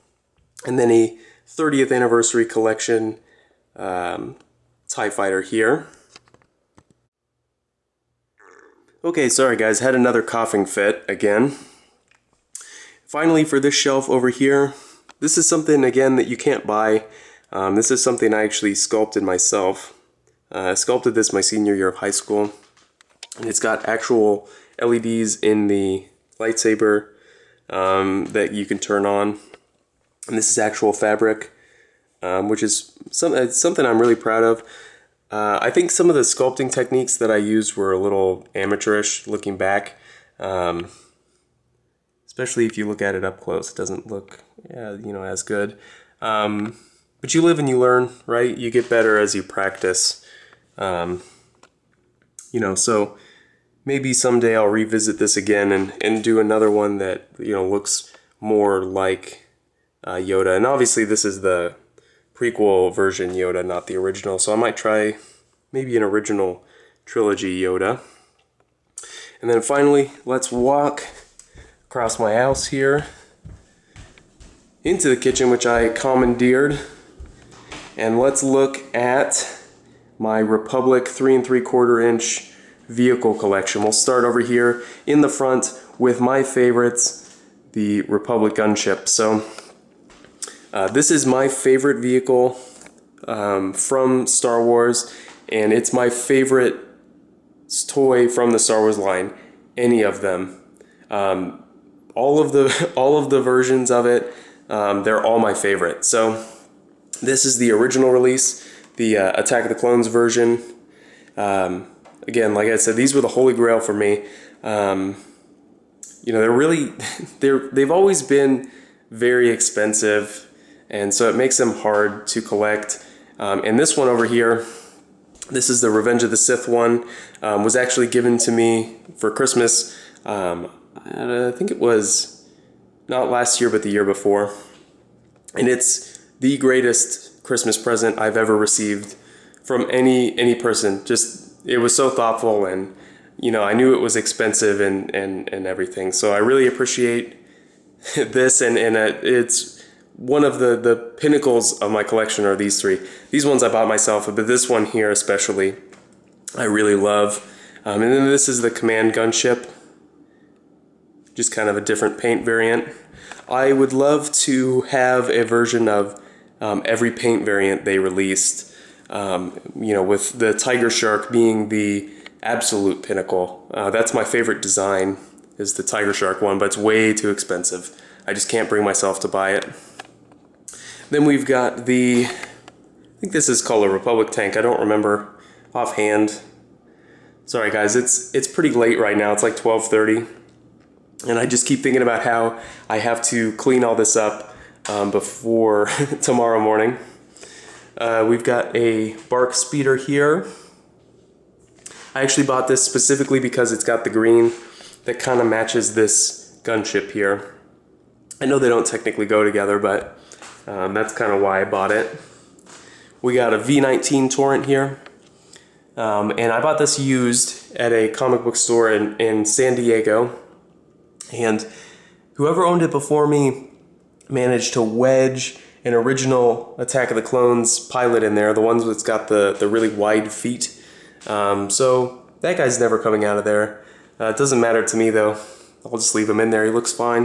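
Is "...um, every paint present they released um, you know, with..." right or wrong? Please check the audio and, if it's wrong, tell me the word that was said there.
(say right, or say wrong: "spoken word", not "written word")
wrong: "variant", not "present".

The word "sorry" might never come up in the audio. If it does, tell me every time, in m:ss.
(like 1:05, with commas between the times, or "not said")
0:09, 3:07.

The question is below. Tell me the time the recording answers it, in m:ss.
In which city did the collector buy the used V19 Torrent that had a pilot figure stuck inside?
3:39.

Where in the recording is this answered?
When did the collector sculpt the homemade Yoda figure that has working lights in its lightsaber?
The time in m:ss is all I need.
0:21.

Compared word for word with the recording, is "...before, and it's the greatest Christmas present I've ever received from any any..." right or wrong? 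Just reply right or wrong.
right.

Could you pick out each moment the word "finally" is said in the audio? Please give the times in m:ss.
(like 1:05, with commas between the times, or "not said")
0:13, 1:09.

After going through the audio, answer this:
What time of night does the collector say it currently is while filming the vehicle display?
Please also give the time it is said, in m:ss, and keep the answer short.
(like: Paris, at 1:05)
12:30, at 3:09.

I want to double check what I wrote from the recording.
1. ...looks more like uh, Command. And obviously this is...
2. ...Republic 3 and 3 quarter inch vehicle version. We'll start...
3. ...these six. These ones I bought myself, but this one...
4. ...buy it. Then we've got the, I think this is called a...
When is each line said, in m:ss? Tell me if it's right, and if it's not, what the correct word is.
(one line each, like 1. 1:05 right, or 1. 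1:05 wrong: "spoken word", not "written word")
1. 0:57 wrong: "Yoda", not "Command"
2. 1:20 wrong: "collection", not "version"
3. 2:32 wrong: "three", not "six"
4. 2:59 right.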